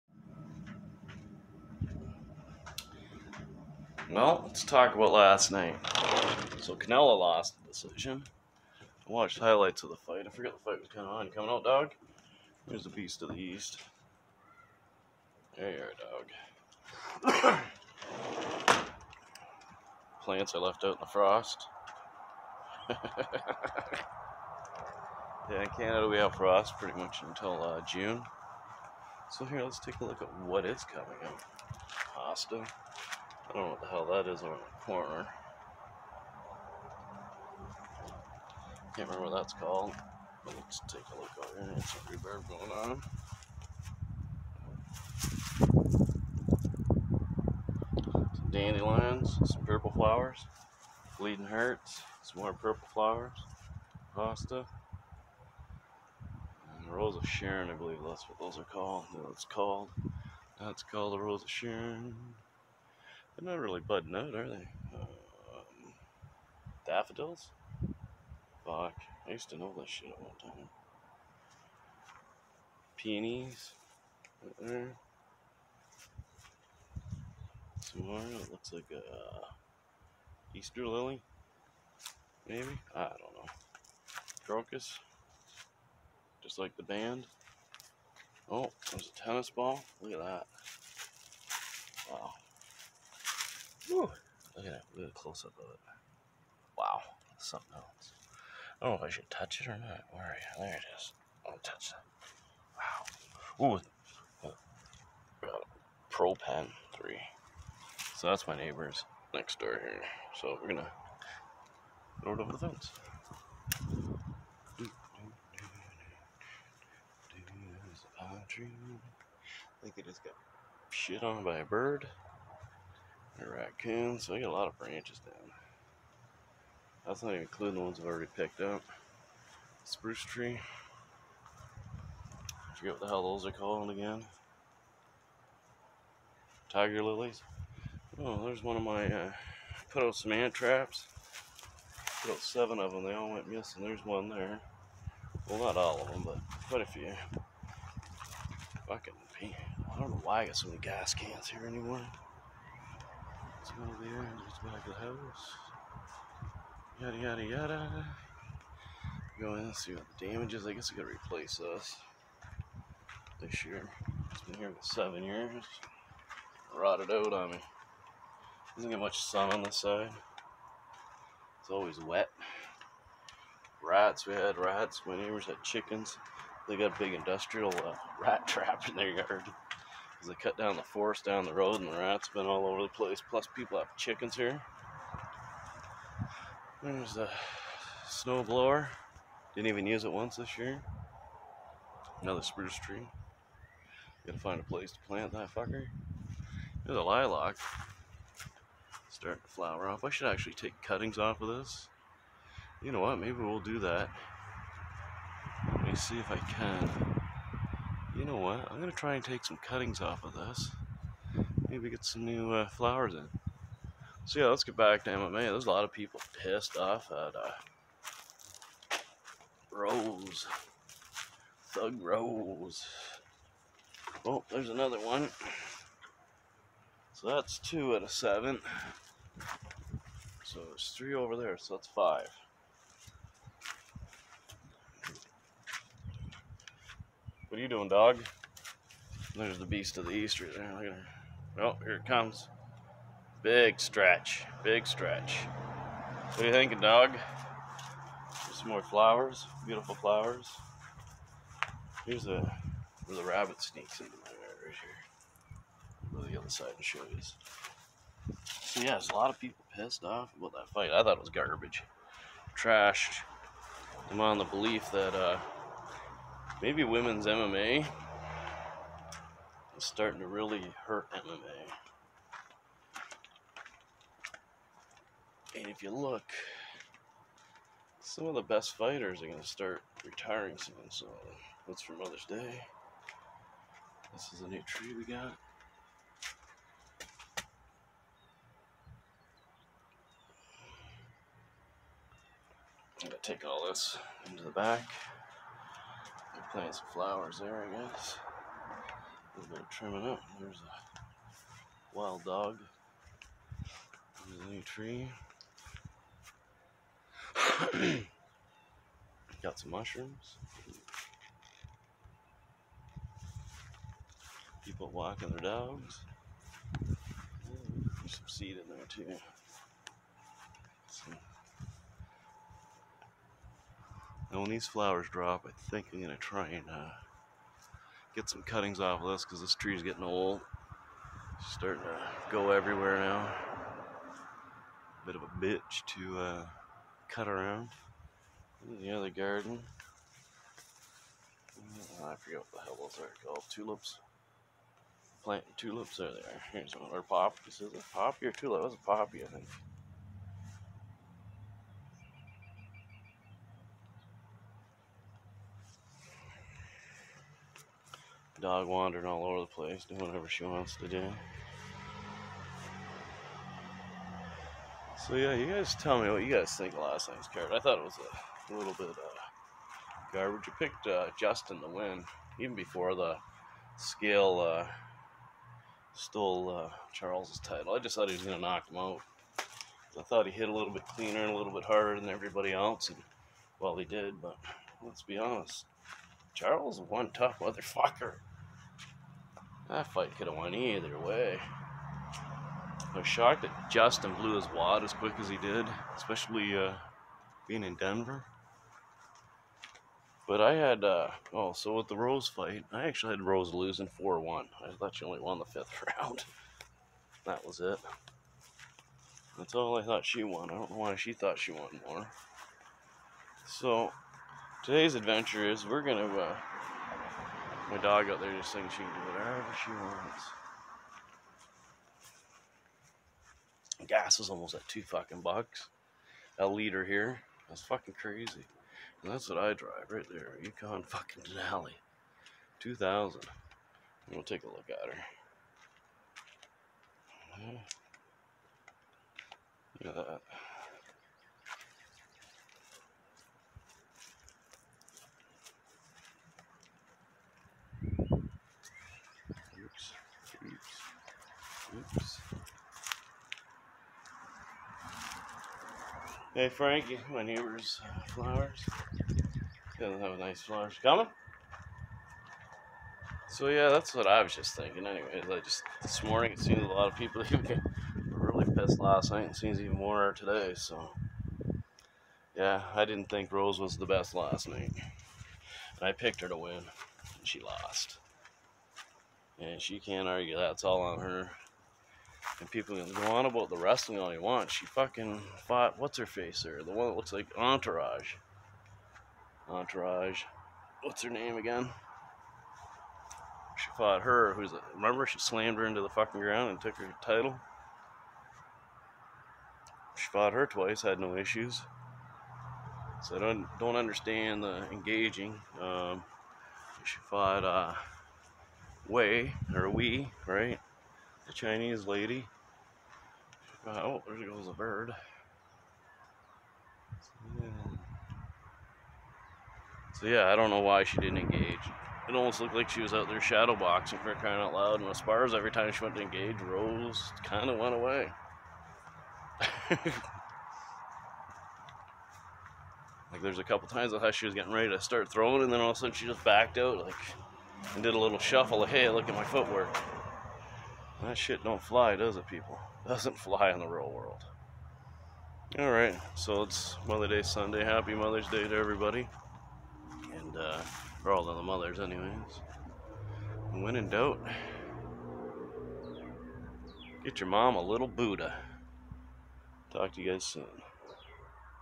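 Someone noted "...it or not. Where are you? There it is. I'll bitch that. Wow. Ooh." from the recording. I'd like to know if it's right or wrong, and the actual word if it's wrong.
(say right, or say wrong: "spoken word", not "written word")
wrong: "touch", not "bitch".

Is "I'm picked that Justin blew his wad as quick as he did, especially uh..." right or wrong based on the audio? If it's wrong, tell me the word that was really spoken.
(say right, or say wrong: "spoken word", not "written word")
wrong: "shocked", not "picked".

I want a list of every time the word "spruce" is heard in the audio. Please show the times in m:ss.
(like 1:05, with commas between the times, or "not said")
2:09, 3:12.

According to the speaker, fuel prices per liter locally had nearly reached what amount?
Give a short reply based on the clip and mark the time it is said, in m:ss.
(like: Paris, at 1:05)
2 dollars, at 7:04.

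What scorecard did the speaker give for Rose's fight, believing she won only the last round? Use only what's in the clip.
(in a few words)
4-1.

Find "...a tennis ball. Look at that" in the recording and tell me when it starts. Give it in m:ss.
1:29.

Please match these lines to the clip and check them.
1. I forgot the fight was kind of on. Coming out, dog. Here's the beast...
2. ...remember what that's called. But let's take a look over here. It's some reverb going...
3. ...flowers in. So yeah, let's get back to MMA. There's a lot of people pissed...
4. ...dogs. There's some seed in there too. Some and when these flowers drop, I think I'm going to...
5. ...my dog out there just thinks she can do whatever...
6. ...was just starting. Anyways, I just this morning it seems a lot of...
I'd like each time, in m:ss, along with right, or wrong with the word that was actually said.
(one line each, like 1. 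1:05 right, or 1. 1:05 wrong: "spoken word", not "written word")
1. 0:10 right
2. 0:39 right
3. 3:32 right
4. 5:15 right
5. 6:57 right
6. 7:44 wrong: "thinking", not "starting".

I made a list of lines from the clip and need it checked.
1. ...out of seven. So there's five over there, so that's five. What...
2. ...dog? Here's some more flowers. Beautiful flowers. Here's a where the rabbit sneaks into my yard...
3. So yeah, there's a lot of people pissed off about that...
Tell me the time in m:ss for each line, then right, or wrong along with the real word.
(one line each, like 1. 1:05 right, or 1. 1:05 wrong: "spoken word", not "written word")
1. 3:47 wrong: "three", not "five"
2. 4:06 right
3. 4:18 right.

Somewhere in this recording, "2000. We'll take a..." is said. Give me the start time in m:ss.
7:12.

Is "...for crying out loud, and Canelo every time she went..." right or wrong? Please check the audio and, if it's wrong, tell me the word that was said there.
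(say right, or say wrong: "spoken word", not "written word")
wrong: "Esparza", not "Canelo".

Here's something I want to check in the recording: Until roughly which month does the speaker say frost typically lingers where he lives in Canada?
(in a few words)
June.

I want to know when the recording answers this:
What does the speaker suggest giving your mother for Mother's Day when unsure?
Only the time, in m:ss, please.
9:17.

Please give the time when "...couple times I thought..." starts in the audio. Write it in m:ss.
8:53.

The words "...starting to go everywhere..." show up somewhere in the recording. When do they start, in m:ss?
5:31.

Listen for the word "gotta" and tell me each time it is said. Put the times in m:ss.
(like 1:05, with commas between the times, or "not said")
2:40, 3:14.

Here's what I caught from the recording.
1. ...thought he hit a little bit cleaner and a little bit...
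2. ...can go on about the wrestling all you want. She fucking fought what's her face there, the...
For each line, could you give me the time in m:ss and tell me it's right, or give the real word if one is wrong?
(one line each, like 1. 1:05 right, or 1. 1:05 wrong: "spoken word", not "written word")
1. 6:20 right
2. 8:02 right.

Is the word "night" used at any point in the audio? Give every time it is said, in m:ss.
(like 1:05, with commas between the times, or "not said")
0:05, 6:07, 7:49, 7:54.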